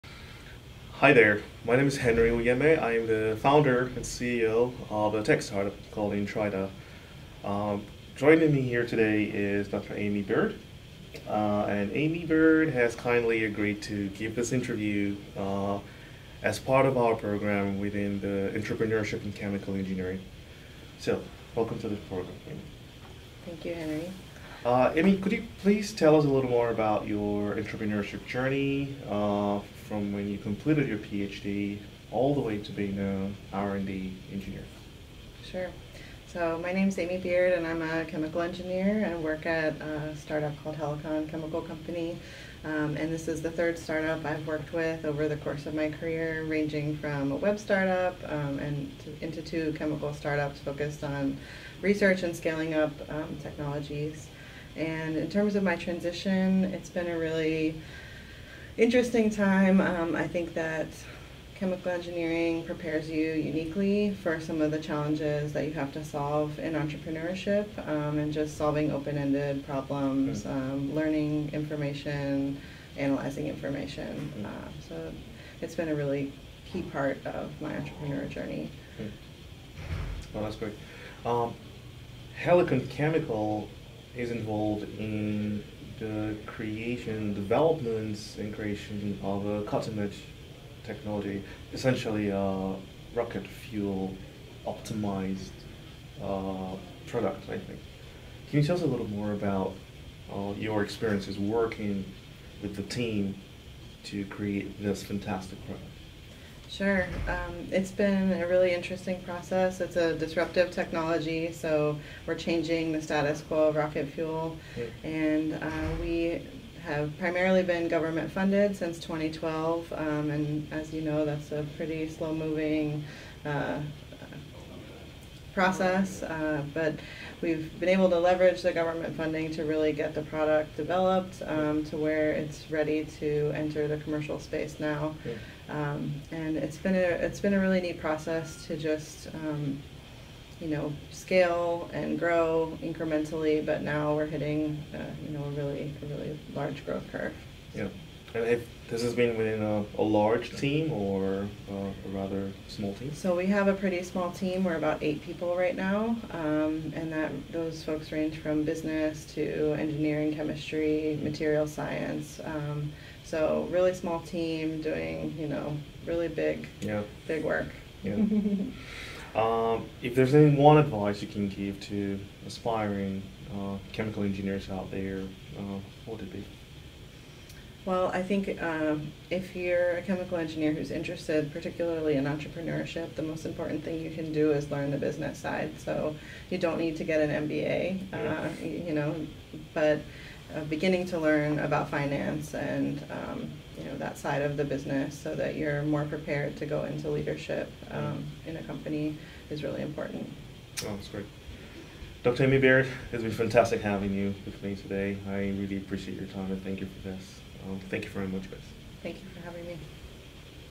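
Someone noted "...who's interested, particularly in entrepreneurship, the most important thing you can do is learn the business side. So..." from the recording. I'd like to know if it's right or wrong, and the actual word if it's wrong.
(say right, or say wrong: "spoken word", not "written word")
right.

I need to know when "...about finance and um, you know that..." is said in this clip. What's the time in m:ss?
3:11.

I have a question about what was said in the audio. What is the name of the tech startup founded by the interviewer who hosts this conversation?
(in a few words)
Intrida.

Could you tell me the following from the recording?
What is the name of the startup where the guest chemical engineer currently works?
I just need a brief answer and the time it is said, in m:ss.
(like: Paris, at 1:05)
Helicon Chemical Company, at 0:40.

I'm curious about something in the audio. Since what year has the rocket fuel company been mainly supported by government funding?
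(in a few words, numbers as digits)
2012.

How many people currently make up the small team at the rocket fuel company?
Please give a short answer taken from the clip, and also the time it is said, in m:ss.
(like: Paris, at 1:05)
8, at 2:35.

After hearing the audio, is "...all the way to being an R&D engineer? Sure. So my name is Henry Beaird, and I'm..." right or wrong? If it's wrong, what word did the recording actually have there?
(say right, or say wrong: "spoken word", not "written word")
wrong: "Amy", not "Henry".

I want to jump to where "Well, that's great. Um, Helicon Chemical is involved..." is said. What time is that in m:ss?
1:20.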